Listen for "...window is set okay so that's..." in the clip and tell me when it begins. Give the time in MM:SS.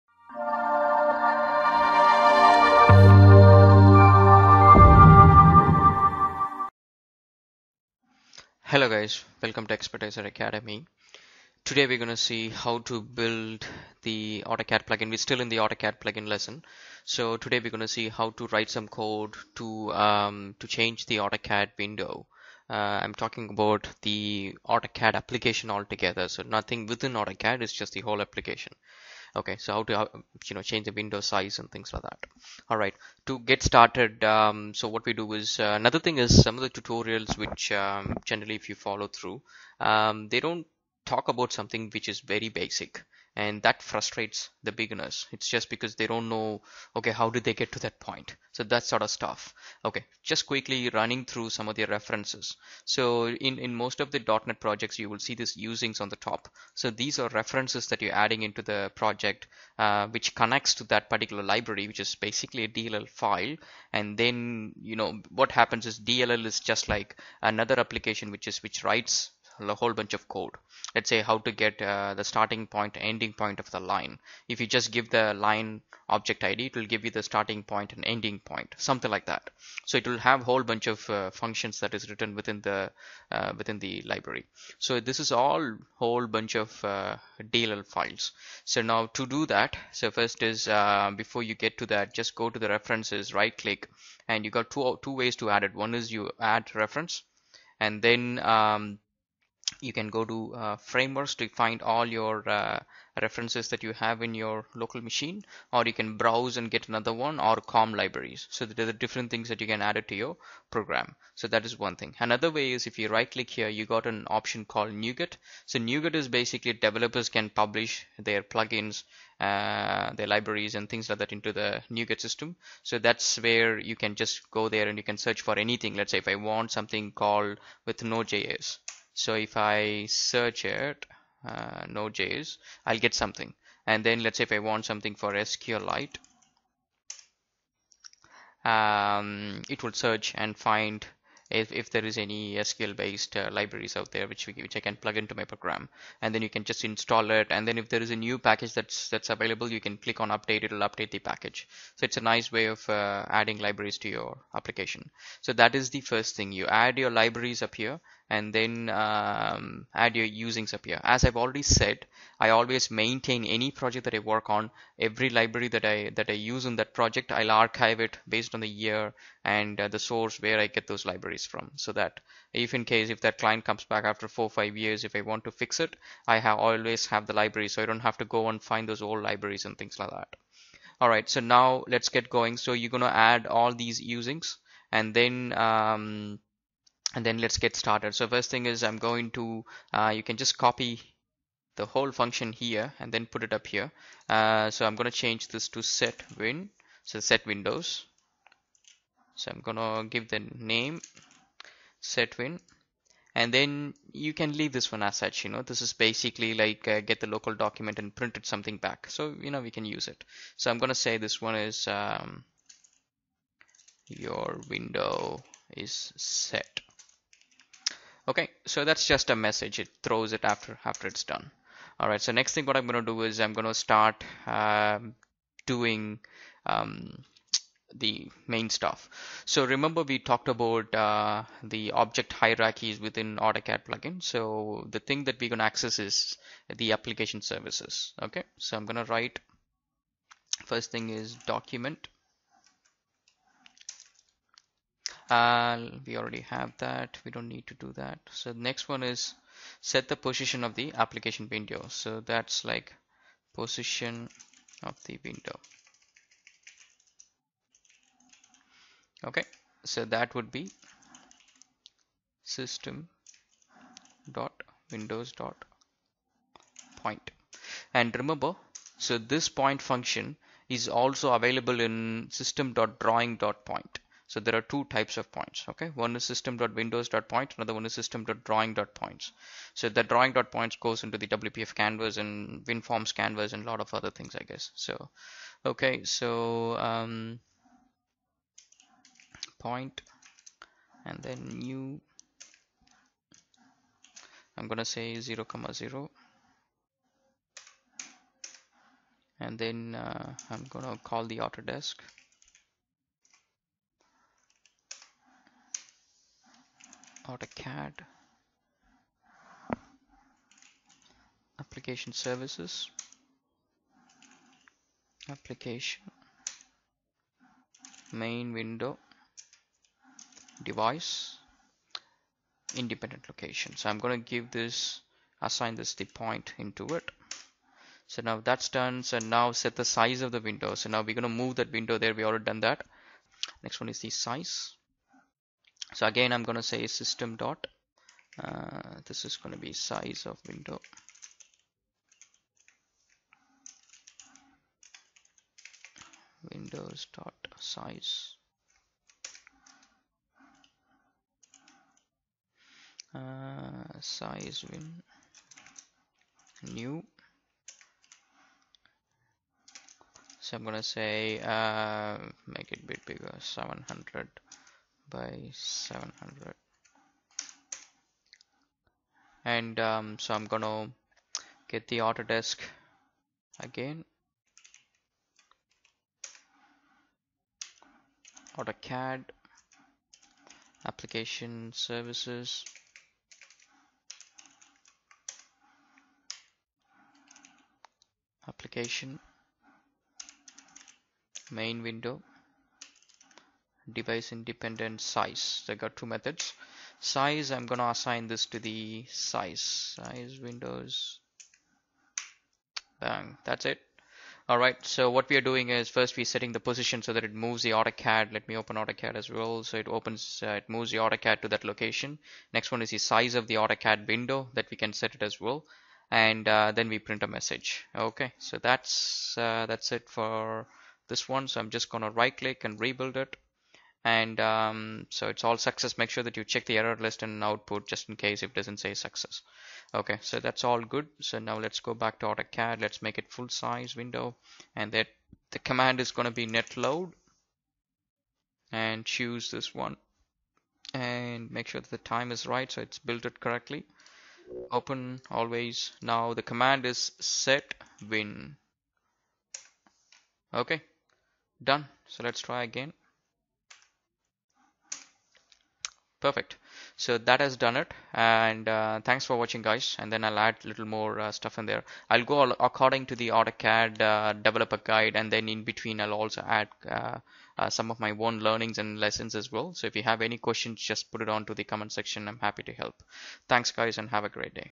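03:34.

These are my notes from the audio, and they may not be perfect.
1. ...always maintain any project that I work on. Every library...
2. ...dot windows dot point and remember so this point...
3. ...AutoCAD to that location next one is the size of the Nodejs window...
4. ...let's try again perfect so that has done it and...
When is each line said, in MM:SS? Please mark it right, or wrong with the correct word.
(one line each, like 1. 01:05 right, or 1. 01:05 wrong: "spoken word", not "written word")
1. 02:42 right
2. 04:24 right
3. 06:50 wrong: "AutoCAD", not "Nodejs"
4. 07:32 right.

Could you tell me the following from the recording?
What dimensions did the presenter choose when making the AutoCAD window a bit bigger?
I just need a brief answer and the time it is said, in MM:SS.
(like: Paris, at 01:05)
700 by 700, at 06:03.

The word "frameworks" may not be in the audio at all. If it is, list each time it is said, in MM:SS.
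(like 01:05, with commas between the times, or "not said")
01:40.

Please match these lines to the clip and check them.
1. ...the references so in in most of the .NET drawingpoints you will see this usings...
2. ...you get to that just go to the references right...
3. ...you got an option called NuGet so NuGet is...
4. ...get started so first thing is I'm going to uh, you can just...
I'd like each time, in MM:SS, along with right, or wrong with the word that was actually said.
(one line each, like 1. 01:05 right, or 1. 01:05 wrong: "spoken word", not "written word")
1. 00:51 wrong: "projects", not "drawingpoints"
2. 01:31 right
3. 01:53 right
4. 03:07 right.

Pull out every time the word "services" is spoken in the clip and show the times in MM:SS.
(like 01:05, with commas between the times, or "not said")
03:57, 05:12, 06:21.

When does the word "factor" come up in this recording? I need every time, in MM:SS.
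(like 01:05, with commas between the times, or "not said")
not said.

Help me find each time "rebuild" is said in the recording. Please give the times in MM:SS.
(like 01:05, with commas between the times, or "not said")
07:02.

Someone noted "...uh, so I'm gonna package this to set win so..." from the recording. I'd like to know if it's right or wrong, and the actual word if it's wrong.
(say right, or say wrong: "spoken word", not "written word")
wrong: "change", not "package".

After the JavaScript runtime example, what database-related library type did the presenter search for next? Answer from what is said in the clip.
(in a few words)
SQLite.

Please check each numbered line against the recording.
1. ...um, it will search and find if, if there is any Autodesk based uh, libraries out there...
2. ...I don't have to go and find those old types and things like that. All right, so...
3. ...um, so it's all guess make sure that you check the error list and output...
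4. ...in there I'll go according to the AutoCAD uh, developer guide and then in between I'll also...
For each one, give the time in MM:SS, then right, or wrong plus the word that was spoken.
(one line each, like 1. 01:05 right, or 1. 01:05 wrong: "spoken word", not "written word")
1. 02:18 wrong: "SQL", not "Autodesk"
2. 02:57 wrong: "libraries", not "types"
3. 07:04 wrong: "success", not "guess"
4. 07:41 right.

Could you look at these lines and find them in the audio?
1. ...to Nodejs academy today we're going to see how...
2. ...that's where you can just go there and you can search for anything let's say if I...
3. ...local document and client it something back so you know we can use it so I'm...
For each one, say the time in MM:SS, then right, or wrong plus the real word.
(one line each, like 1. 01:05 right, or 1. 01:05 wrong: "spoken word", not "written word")
1. 00:09 wrong: "Expertisor", not "Nodejs"
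2. 02:02 right
3. 03:27 wrong: "print", not "client".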